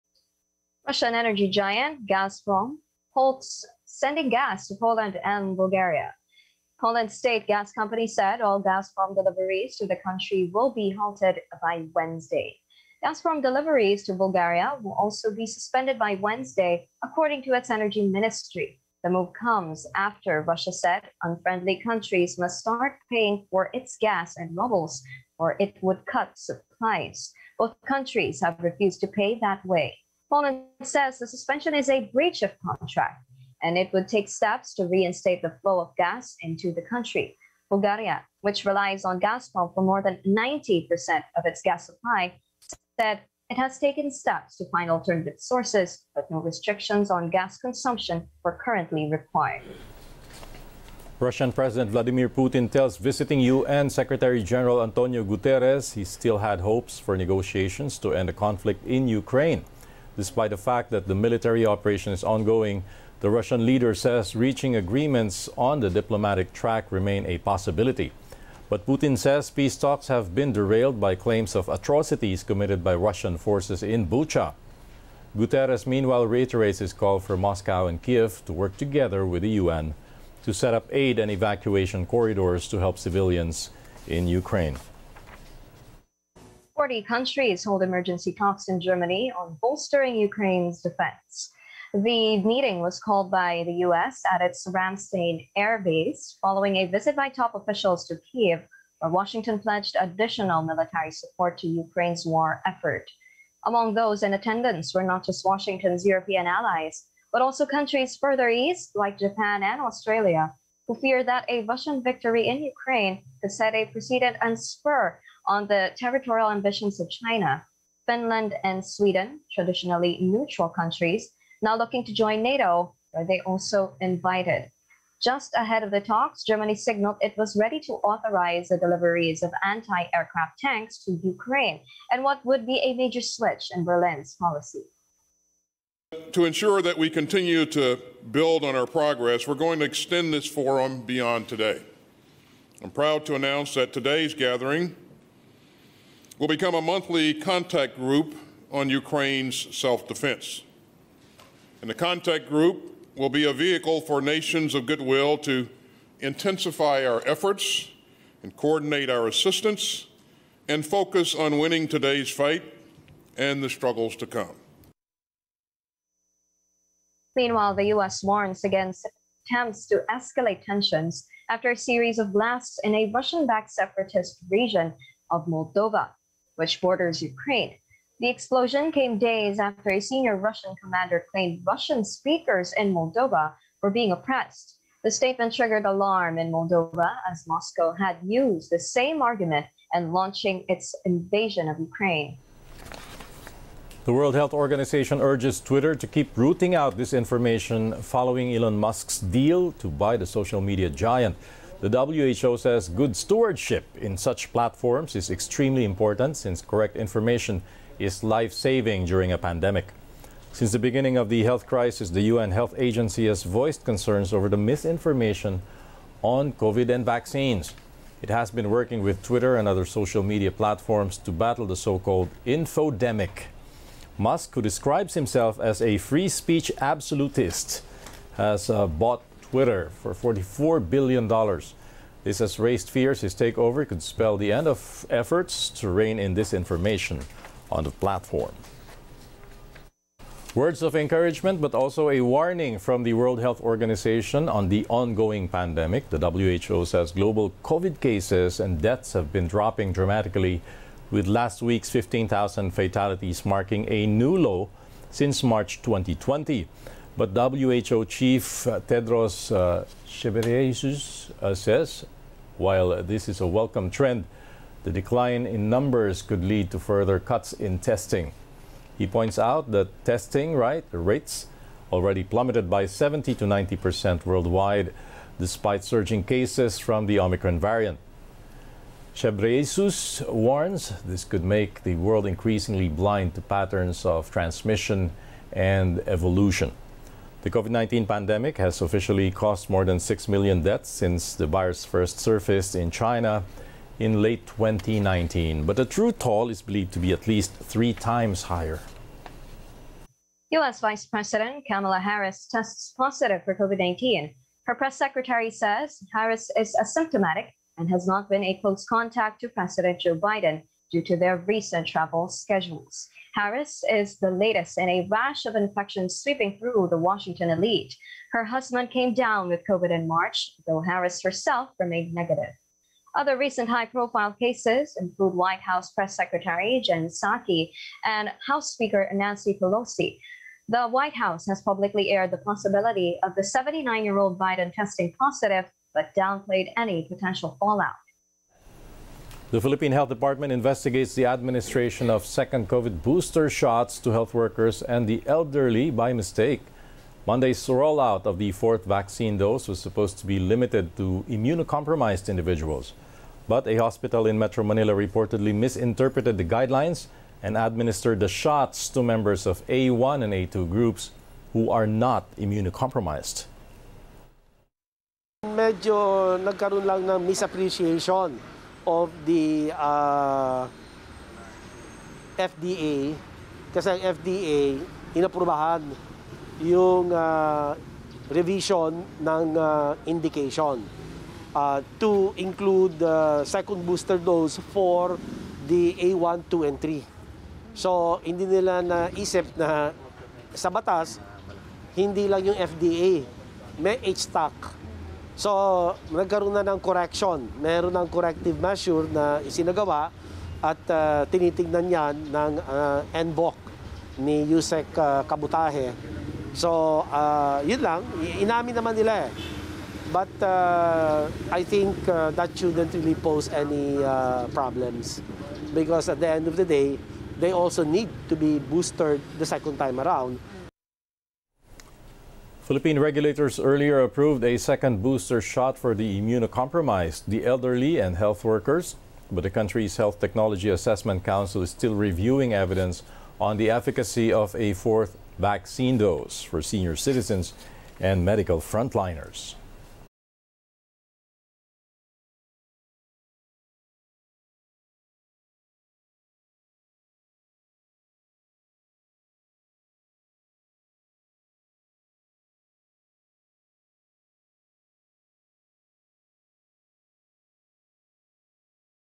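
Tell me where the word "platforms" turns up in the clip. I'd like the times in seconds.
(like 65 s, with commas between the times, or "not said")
204 s, 220 s, 237 s.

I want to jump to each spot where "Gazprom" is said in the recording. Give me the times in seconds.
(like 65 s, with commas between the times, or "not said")
2 s, 8 s, 13 s, 39 s.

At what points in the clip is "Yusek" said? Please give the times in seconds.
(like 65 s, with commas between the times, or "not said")
404 s.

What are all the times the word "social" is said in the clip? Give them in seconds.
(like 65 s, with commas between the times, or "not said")
200 s, 219 s.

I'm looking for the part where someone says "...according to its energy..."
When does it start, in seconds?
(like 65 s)
17 s.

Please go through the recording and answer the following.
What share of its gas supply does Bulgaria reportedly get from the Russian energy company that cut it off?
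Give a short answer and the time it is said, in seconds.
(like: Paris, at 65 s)
more than 90%, at 39 s.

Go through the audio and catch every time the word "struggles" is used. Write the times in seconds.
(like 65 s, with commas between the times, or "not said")
163 s.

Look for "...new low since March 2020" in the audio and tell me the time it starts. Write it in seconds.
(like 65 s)
254 s.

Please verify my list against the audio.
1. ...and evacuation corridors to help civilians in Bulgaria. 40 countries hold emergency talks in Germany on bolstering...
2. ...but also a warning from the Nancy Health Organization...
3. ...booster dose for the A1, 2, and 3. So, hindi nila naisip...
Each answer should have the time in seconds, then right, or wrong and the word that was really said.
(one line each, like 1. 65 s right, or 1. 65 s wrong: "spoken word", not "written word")
1. 81 s wrong: "Ukraine", not "Bulgaria"
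2. 241 s wrong: "World", not "Nancy"
3. 383 s right.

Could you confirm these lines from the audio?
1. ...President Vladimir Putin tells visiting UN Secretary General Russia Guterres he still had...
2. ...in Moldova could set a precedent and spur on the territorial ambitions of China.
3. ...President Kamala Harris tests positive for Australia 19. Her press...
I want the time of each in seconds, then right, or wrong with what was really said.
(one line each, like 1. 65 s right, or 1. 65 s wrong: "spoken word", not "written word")
1. 51 s wrong: "Antonio", not "Russia"
2. 112 s wrong: "Ukraine", not "Moldova"
3. 301 s wrong: "COVID", not "Australia".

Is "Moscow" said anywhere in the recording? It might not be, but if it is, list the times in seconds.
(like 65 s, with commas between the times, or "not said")
77 s, 187 s.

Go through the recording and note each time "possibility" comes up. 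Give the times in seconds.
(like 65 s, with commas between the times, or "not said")
67 s, 332 s.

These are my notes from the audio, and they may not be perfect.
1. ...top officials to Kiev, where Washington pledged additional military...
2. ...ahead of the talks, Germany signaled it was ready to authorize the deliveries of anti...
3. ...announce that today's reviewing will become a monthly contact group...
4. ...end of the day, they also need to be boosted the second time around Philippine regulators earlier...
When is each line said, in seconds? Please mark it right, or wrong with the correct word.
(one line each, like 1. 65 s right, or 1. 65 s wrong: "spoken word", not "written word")
1. 97 s right
2. 125 s right
3. 143 s wrong: "gathering", not "reviewing"
4. 416 s right.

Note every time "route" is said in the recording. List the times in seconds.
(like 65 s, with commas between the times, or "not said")
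not said.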